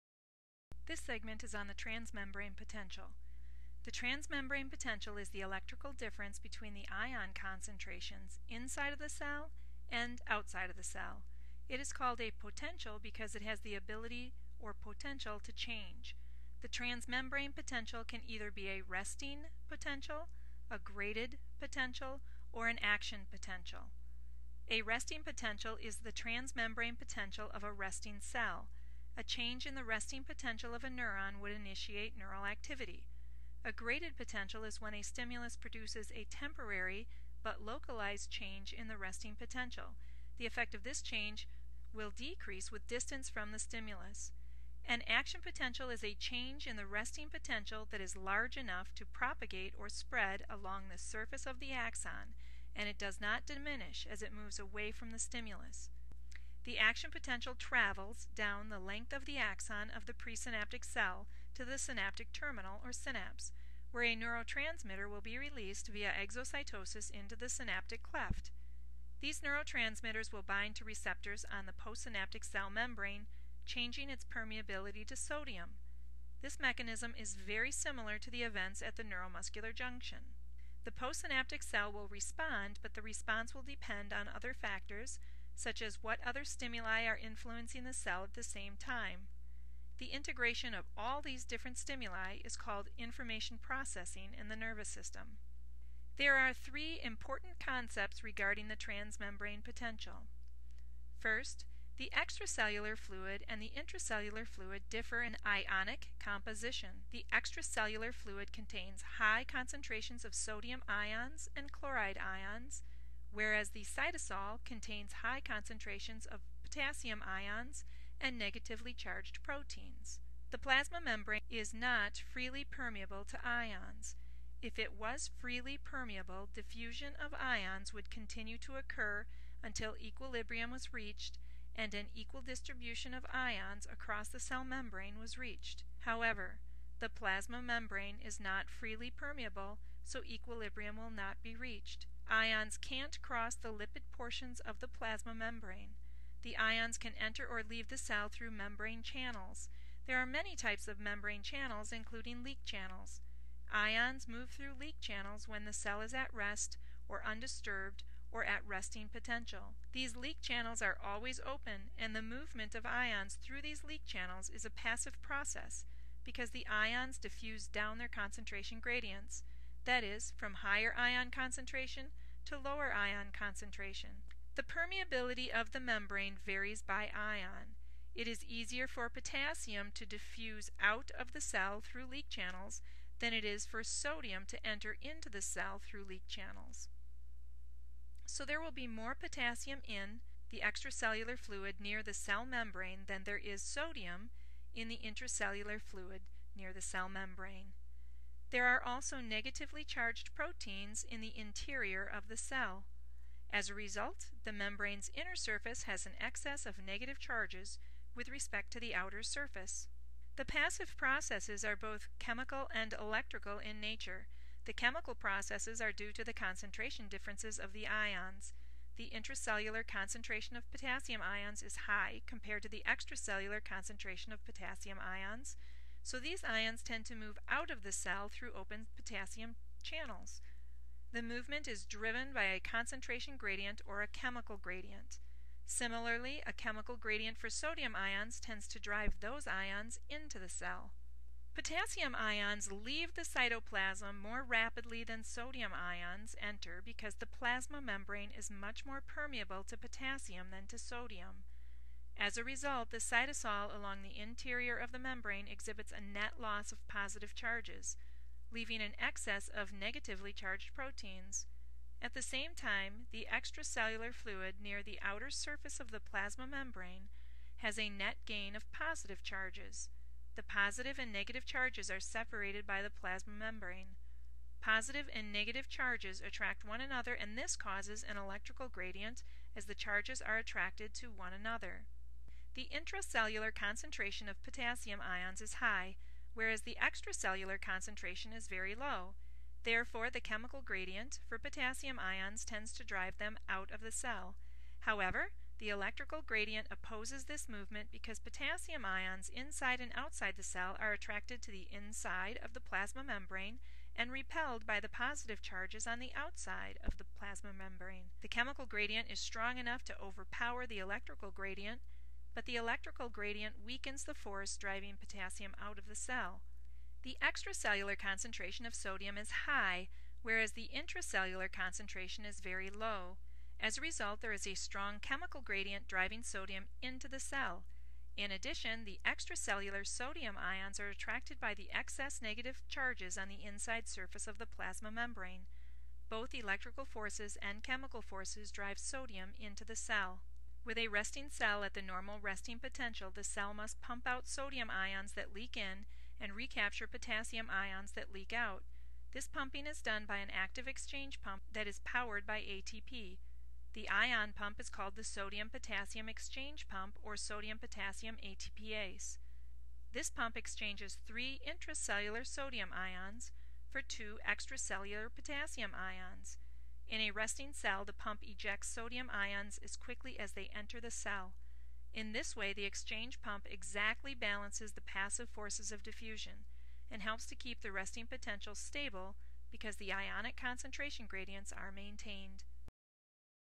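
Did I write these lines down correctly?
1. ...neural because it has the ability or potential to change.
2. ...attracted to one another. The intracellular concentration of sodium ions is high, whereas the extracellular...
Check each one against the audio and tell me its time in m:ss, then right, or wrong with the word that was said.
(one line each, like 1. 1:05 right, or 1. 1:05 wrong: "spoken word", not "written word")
1. 0:12 wrong: "potential", not "neural"
2. 4:40 wrong: "potassium", not "sodium".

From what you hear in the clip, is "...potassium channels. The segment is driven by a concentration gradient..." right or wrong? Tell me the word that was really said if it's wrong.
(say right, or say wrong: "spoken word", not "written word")
wrong: "movement", not "segment".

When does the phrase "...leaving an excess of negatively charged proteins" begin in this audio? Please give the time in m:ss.
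4:18.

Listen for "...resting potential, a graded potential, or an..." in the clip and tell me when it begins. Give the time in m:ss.
0:18.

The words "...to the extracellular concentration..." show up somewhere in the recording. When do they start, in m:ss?
3:42.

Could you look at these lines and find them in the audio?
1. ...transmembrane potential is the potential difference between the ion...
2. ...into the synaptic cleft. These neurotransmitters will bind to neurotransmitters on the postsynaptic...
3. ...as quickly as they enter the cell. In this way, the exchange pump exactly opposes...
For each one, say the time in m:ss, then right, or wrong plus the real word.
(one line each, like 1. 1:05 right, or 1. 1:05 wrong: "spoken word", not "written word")
1. 0:03 wrong: "electrical", not "potential"
2. 1:07 wrong: "receptors", not "neurotransmitters"
3. 6:09 wrong: "balances", not "opposes".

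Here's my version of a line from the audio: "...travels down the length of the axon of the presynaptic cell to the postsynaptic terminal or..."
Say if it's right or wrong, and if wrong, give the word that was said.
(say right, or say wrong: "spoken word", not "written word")
wrong: "synaptic", not "postsynaptic".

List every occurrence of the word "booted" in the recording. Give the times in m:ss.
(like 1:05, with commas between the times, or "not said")
not said.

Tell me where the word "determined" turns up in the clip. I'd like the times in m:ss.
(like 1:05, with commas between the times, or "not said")
not said.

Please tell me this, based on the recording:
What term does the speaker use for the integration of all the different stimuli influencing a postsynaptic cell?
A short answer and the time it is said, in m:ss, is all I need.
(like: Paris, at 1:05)
Information processing, at 1:32.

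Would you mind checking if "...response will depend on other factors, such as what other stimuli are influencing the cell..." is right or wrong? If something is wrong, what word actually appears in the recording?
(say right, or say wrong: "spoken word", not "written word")
right.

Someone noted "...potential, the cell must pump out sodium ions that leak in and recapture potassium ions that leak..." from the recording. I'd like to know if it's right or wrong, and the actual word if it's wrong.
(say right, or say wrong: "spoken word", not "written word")
right.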